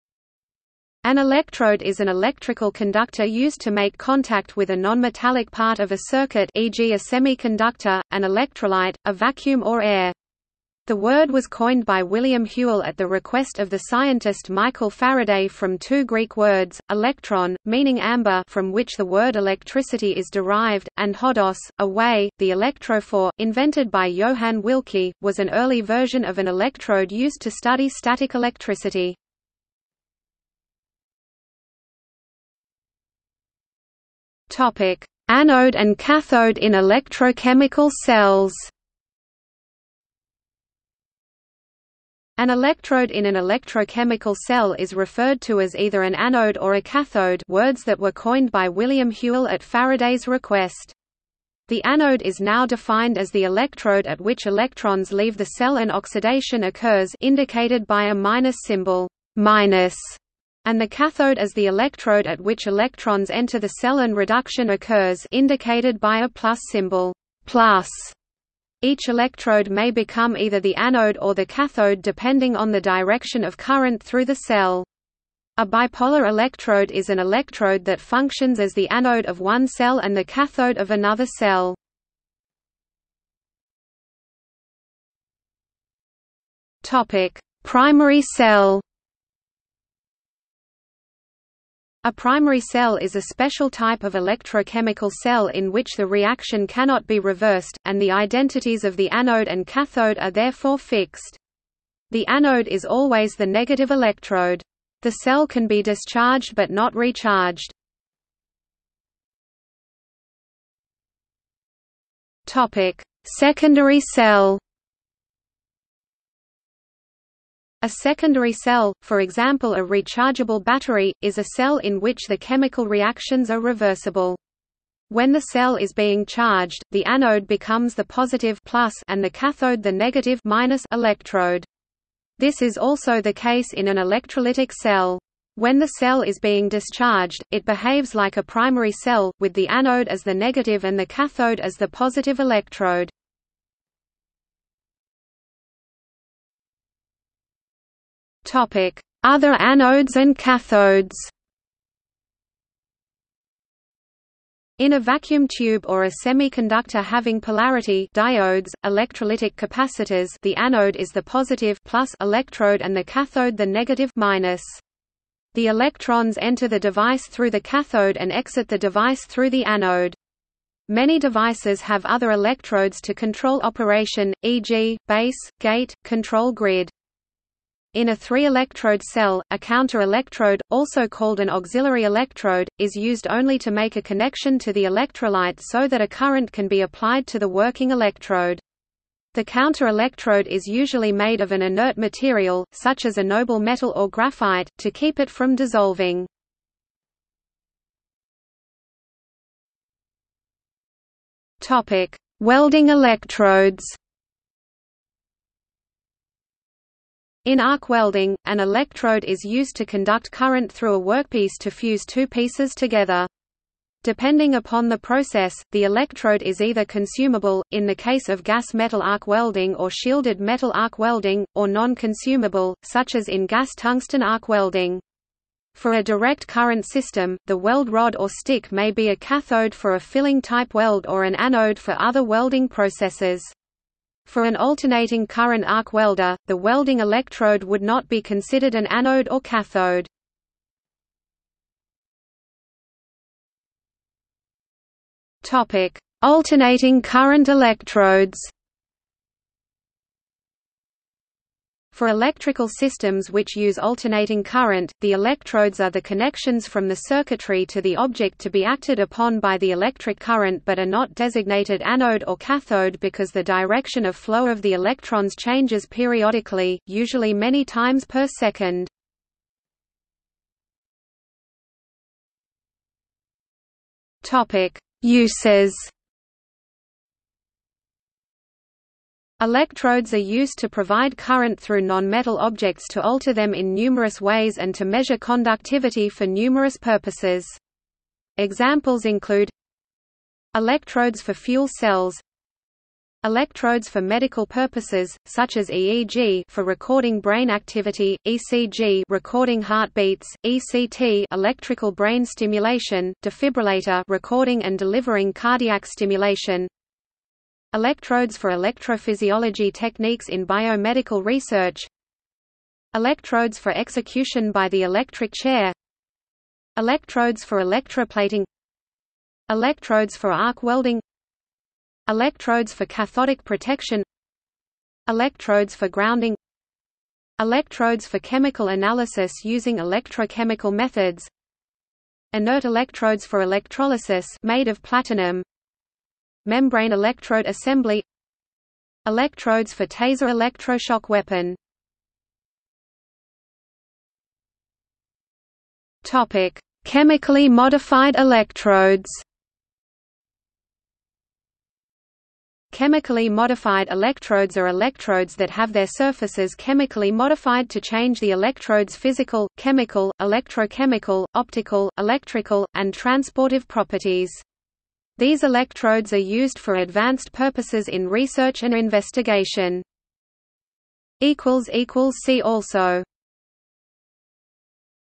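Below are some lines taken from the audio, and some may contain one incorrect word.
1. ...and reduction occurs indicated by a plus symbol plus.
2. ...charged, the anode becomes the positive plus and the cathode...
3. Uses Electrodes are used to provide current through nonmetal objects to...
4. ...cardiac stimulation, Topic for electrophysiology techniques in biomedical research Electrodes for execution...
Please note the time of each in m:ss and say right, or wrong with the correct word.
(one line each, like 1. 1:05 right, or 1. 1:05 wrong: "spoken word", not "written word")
1. 1:03 right
2. 2:06 right
3. 4:35 right
4. 5:05 wrong: "Electrodes", not "Topic".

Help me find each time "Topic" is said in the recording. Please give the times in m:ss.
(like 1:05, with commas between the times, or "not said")
0:34, 5:46.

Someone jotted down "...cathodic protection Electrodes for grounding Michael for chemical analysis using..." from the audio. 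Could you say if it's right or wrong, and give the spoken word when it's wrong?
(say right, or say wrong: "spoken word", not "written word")
wrong: "Electrodes", not "Michael".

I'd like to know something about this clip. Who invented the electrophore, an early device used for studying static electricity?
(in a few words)
Johann Wilcke.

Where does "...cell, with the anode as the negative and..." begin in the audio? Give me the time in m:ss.
2:18.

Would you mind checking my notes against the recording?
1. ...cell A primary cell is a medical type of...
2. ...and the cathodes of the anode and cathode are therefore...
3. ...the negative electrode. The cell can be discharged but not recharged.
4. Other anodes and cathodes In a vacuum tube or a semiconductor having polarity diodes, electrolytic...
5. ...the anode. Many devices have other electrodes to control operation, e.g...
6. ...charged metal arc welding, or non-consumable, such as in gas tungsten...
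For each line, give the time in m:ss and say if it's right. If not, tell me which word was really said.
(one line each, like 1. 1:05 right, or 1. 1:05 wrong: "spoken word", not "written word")
1. 1:28 wrong: "special", not "medical"
2. 1:37 wrong: "identities", not "cathodes"
3. 1:43 right
4. 2:29 right
5. 2:49 right
6. 3:39 wrong: "shielded", not "charged".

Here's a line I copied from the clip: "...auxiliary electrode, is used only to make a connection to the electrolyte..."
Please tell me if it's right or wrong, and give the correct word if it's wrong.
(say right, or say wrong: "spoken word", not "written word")
right.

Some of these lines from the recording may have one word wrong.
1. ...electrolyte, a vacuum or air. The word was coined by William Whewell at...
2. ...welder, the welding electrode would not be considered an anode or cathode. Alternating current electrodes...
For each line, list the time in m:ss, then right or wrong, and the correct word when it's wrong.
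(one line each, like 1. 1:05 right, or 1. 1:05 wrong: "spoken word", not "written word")
1. 0:08 right
2. 3:55 right.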